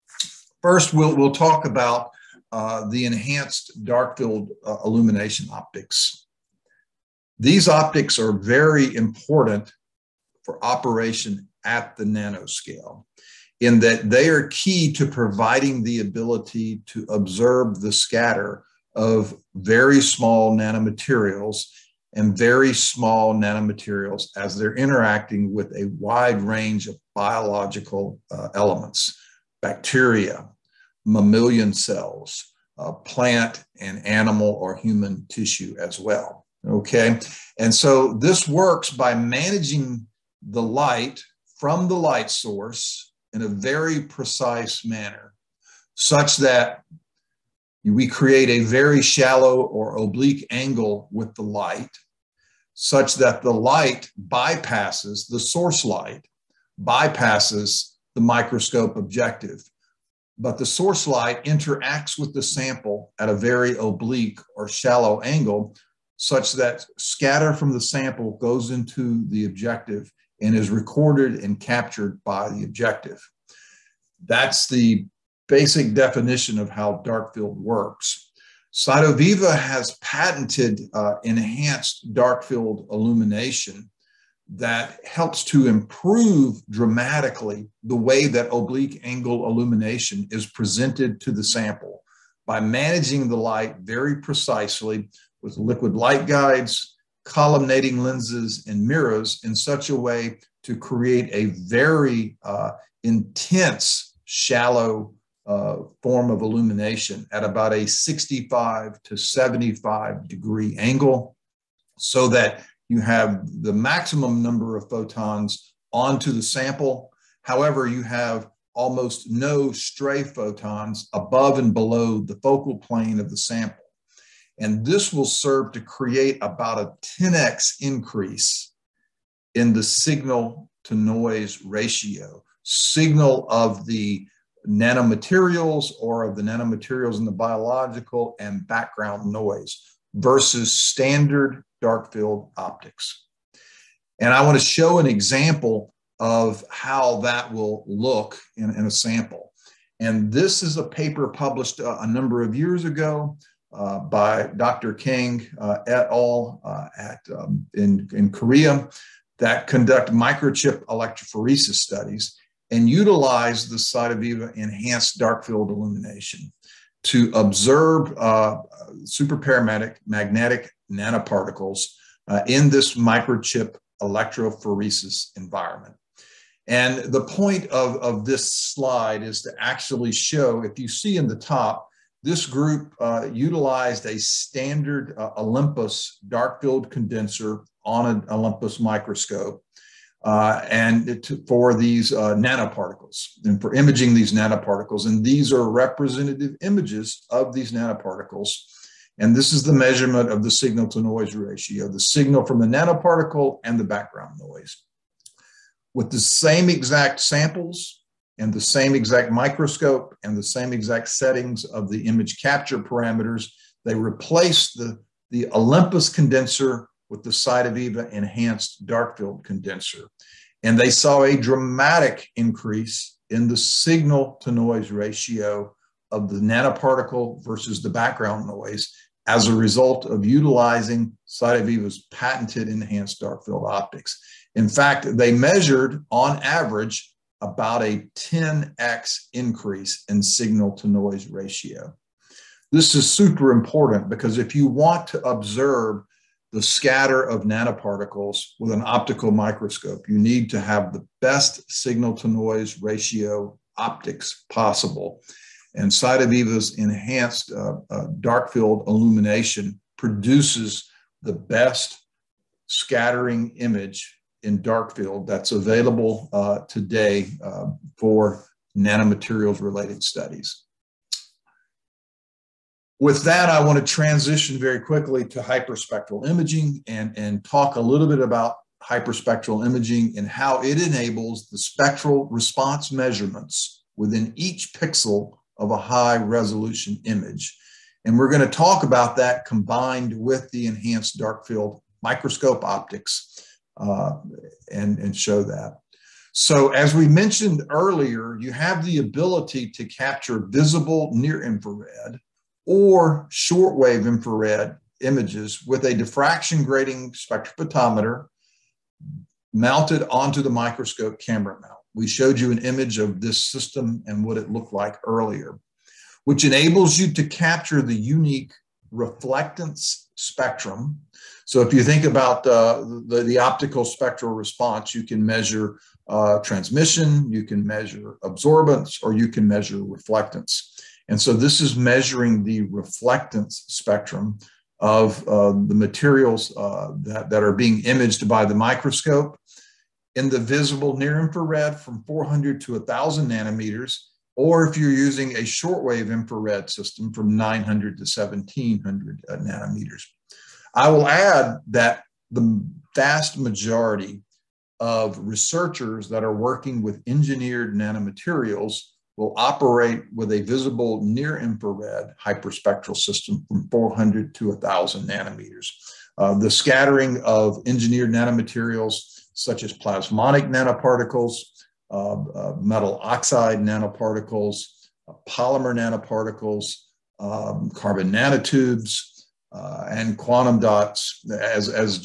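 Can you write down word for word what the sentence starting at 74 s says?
That's the basic definition of how dark field works.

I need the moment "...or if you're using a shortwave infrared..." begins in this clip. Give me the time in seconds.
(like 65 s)
344 s.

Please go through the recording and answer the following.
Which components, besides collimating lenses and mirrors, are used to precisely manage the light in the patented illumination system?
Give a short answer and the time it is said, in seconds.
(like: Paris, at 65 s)
liquid light guides, at 95 s.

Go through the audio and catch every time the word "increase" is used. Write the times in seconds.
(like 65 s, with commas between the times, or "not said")
127 s, 222 s, 239 s.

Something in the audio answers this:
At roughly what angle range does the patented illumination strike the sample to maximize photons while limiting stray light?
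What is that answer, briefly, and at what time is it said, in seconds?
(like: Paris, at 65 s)
65 to 75 degrees, at 107 s.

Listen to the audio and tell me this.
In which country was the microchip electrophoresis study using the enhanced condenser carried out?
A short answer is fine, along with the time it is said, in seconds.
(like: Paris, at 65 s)
Korea, at 158 s.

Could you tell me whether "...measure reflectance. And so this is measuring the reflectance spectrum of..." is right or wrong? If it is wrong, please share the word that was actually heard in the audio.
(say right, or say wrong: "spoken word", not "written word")
right.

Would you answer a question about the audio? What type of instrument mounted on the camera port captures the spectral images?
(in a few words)
diffraction grating spectrophotometer.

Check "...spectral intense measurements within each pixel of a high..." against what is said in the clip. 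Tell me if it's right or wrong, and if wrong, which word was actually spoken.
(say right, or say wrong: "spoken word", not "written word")
wrong: "response", not "intense".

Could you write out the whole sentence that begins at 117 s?
However, you have almost no stray photons above and below the focal plane of the sample.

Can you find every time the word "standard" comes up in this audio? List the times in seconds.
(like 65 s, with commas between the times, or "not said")
140 s, 184 s.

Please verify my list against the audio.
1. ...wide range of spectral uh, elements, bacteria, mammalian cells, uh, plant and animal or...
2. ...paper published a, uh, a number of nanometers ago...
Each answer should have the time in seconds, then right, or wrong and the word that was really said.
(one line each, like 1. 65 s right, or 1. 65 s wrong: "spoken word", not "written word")
1. 25 s wrong: "biological", not "spectral"
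2. 150 s wrong: "years", not "nanometers".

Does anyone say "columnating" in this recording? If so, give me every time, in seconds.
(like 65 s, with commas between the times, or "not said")
97 s.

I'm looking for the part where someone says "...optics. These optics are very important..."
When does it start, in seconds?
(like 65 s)
5 s.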